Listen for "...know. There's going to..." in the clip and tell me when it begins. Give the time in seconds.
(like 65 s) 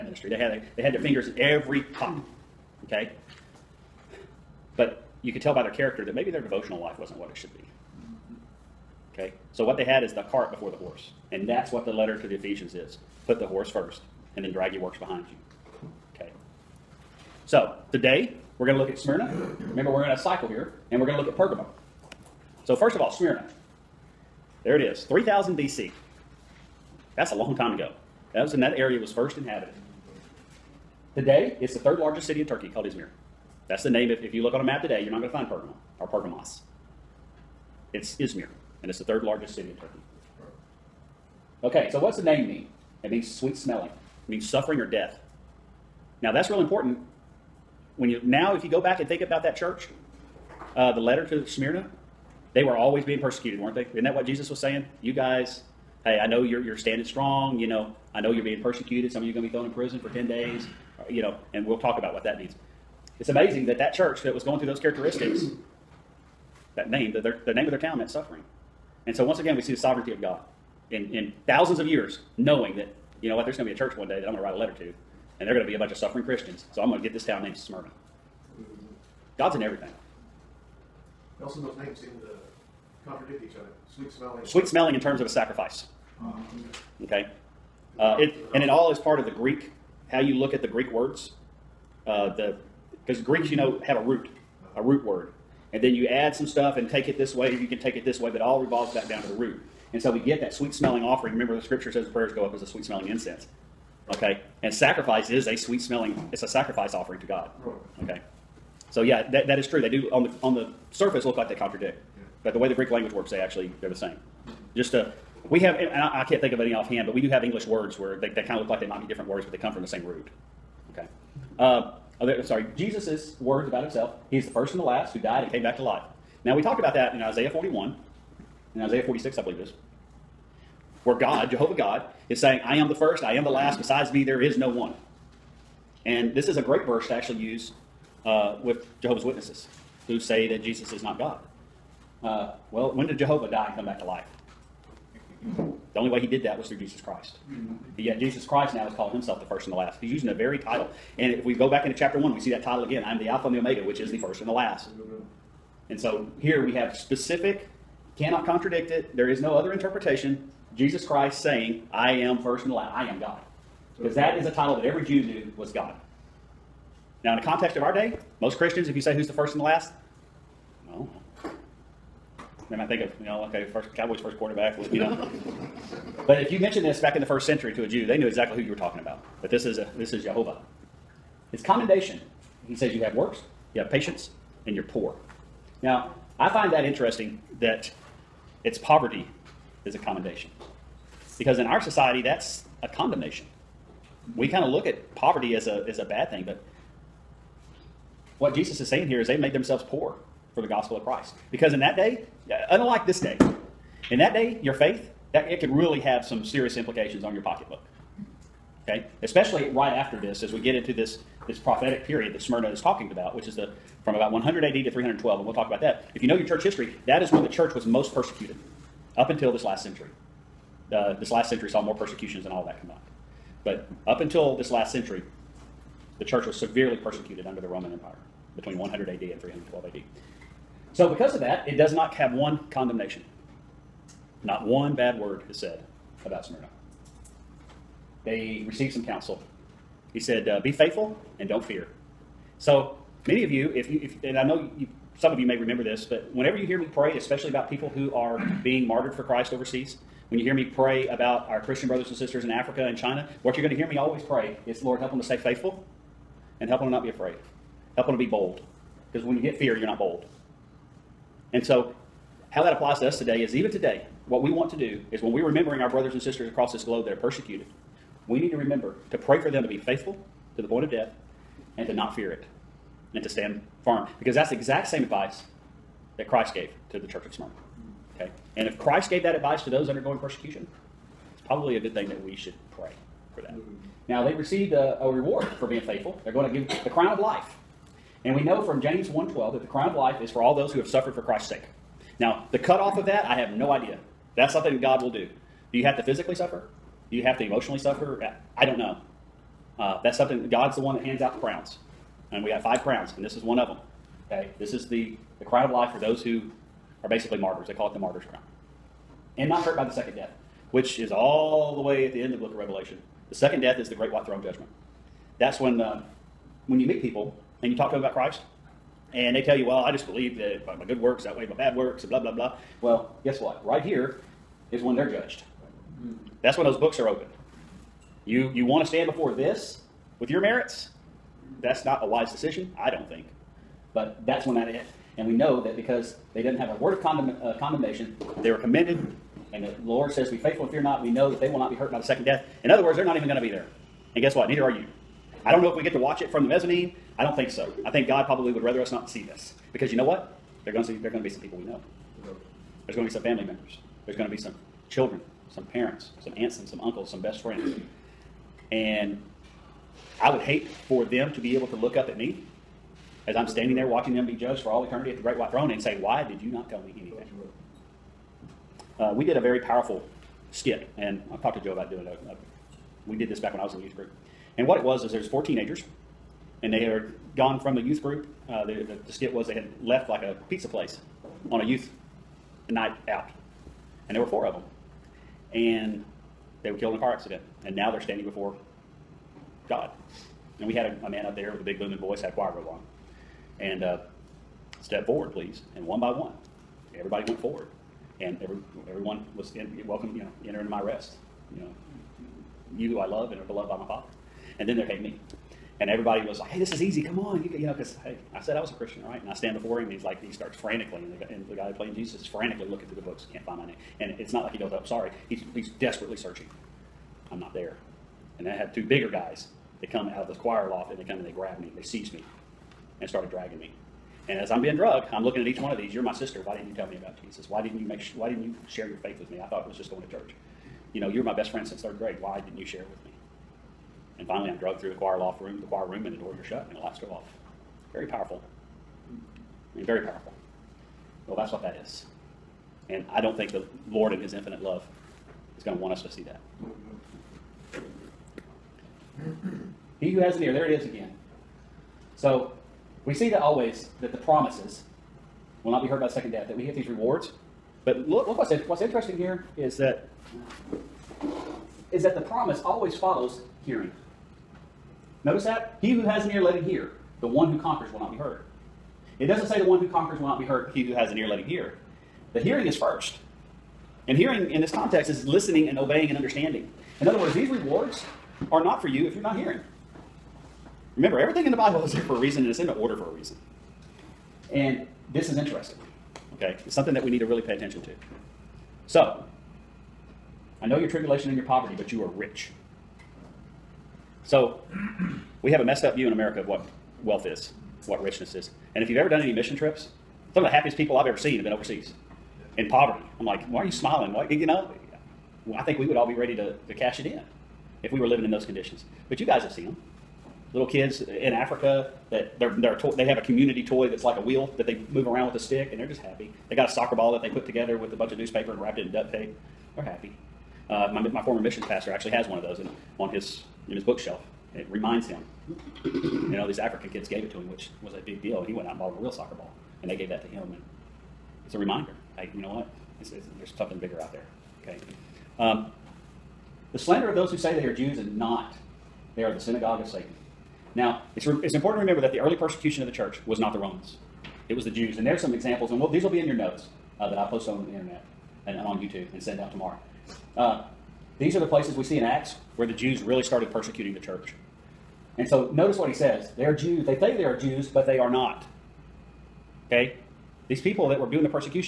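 351 s.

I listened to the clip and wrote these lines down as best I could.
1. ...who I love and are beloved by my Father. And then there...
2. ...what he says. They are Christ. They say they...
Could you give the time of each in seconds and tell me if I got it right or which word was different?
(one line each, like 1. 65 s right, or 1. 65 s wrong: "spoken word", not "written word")
1. 402 s right
2. 555 s wrong: "Jews", not "Christ".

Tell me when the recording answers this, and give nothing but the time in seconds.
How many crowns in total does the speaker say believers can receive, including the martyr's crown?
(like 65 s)
302 s.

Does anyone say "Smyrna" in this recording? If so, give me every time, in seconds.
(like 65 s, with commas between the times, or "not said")
18 s, 23 s, 51 s, 77 s, 212 s, 236 s, 277 s.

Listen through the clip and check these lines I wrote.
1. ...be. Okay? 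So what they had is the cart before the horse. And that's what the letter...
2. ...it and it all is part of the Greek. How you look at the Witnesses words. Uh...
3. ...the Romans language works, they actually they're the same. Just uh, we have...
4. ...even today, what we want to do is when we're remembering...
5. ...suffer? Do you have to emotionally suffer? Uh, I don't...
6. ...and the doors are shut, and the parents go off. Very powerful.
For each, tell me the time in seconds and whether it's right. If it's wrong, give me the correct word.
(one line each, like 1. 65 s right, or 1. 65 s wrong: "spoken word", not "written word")
1. 7 s right
2. 88 s wrong: "Greek", not "Witnesses"
3. 112 s wrong: "Greek", not "Romans"
4. 263 s right
5. 296 s right
6. 436 s wrong: "lights", not "parents".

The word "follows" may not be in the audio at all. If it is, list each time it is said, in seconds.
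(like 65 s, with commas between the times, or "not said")
462 s.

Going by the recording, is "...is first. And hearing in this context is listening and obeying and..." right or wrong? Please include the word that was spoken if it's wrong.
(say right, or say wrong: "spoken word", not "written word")
right.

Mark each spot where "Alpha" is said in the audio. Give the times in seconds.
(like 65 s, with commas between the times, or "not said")
153 s.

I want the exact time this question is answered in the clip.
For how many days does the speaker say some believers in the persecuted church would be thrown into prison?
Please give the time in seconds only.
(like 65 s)
59 s.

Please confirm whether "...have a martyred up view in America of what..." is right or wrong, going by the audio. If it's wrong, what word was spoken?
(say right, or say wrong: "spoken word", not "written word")
wrong: "messed", not "martyred".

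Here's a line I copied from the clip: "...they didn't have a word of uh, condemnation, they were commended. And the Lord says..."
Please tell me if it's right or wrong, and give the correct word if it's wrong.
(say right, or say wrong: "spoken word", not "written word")
right.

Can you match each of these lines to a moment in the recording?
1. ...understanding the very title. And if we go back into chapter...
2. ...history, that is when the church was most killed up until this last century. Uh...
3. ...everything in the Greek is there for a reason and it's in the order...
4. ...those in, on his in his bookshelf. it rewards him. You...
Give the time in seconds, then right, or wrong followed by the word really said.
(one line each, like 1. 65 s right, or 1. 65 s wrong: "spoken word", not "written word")
1. 150 s wrong: "using", not "understanding"
2. 216 s wrong: "persecuted", not "killed"
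3. 481 s wrong: "Bible", not "Greek"
4. 522 s wrong: "reminds", not "rewards".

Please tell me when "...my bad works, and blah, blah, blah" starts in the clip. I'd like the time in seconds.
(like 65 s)
321 s.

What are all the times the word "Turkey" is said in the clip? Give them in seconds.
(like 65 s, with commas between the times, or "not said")
32 s, 39 s.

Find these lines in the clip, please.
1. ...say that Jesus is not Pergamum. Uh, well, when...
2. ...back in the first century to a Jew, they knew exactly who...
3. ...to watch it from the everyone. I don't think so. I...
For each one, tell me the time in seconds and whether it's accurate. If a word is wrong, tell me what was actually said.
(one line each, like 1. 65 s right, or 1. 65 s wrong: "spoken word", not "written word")
1. 140 s wrong: "God", not "Pergamum"
2. 176 s right
3. 345 s wrong: "mezzanine", not "everyone".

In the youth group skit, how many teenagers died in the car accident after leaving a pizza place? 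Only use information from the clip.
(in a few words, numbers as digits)
4.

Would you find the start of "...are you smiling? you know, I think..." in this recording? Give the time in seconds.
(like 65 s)
503 s.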